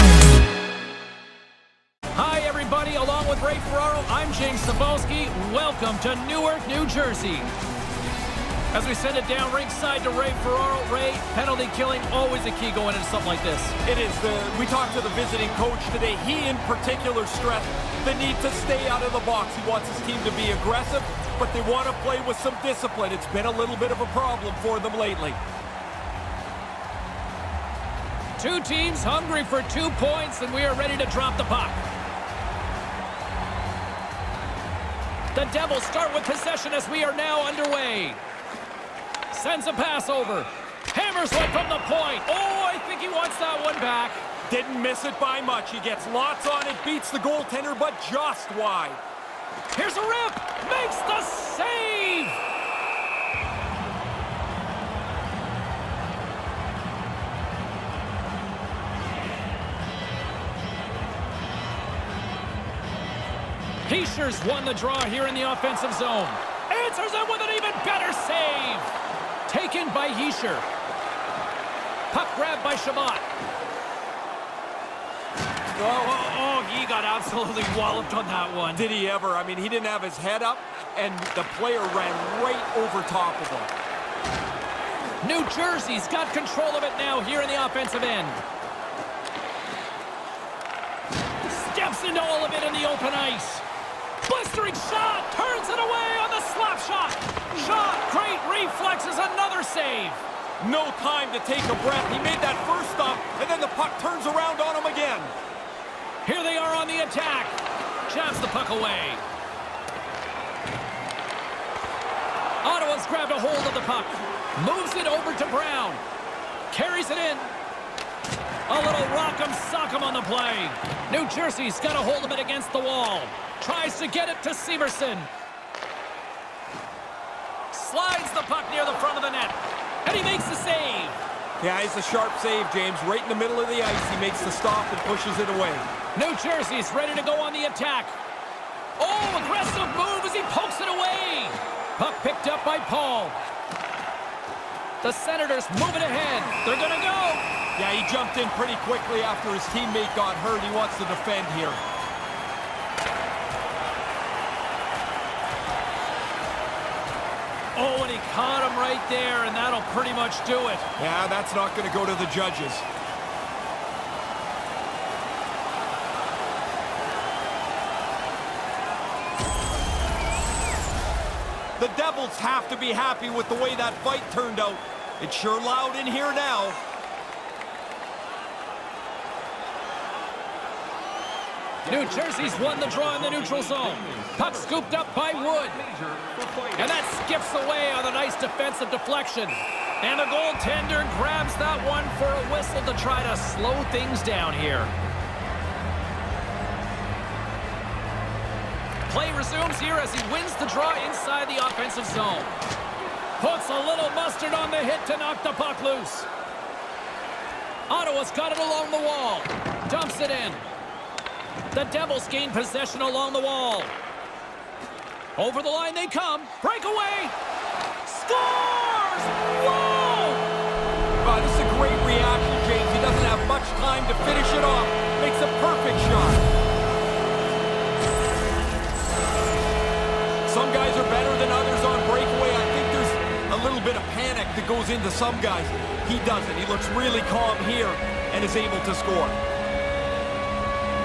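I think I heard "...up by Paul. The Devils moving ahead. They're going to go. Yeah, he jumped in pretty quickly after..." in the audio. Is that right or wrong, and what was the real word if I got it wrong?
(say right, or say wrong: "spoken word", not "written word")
wrong: "Senators", not "Devils".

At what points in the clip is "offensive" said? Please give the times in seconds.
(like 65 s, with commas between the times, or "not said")
65 s, 87 s, 201 s.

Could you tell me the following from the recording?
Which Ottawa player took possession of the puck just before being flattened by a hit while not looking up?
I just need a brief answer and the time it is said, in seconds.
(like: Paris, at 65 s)
Chabot, at 72 s.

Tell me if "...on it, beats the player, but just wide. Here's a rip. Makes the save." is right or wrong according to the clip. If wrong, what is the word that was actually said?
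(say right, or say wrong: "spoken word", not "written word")
wrong: "goaltender", not "player".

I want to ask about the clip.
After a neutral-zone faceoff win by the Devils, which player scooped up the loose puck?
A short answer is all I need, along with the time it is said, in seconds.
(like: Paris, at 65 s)
Wood, at 185 s.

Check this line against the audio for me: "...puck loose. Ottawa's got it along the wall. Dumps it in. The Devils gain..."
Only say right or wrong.
right.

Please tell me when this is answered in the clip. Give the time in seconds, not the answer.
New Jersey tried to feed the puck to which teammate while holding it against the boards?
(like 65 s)
124 s.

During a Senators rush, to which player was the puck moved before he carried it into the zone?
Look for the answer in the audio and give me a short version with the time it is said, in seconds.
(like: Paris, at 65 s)
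Brown, at 115 s.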